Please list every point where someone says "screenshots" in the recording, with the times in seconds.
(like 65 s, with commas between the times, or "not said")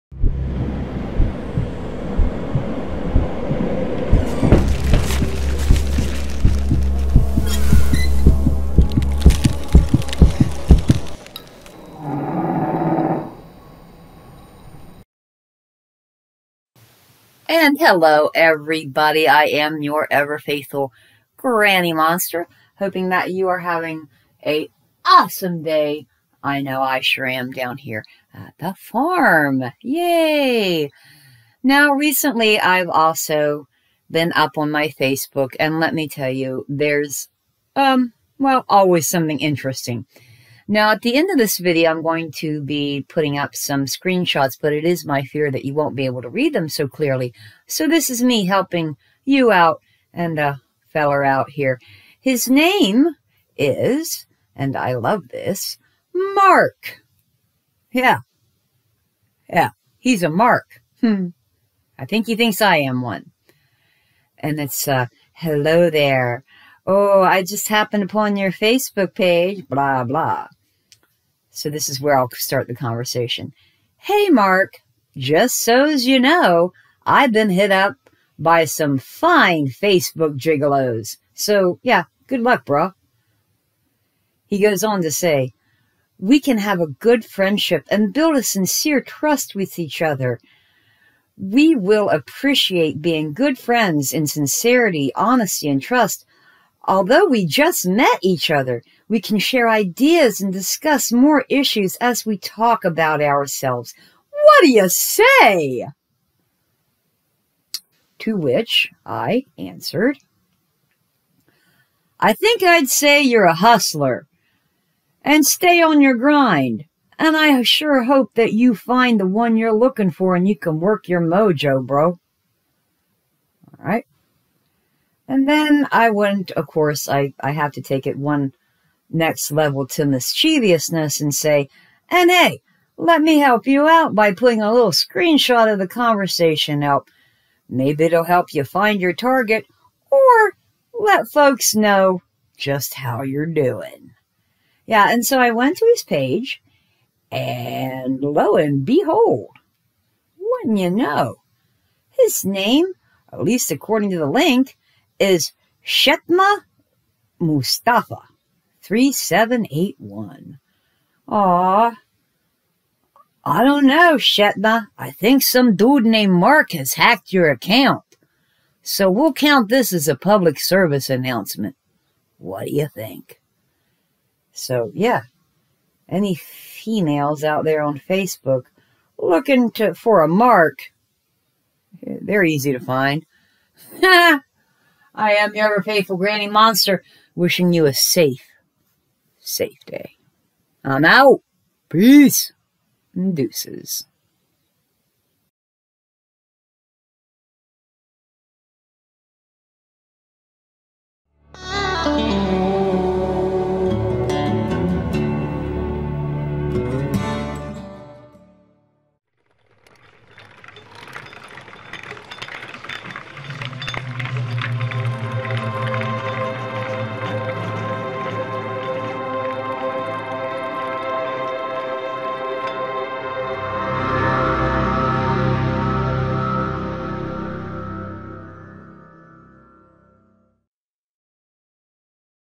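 43 s, 134 s.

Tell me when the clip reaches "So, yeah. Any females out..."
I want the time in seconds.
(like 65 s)
174 s.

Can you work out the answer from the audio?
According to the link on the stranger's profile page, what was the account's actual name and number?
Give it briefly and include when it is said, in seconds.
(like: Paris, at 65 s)
Shetma Mustafa 3781, at 155 s.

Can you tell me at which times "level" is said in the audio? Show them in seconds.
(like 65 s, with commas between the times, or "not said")
129 s.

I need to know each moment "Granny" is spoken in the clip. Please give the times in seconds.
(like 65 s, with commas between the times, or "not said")
21 s, 186 s.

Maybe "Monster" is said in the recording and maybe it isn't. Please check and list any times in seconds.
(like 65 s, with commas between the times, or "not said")
21 s, 186 s.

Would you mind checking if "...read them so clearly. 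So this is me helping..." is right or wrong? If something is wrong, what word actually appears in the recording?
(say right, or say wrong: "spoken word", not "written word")
right.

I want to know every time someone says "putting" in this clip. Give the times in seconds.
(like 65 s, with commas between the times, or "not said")
43 s, 134 s.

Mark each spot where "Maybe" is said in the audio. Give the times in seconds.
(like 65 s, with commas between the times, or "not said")
137 s.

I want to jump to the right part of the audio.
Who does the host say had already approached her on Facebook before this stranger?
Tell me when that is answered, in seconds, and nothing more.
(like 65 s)
79 s.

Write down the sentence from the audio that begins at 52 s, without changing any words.
His name is, and I love this, Mark.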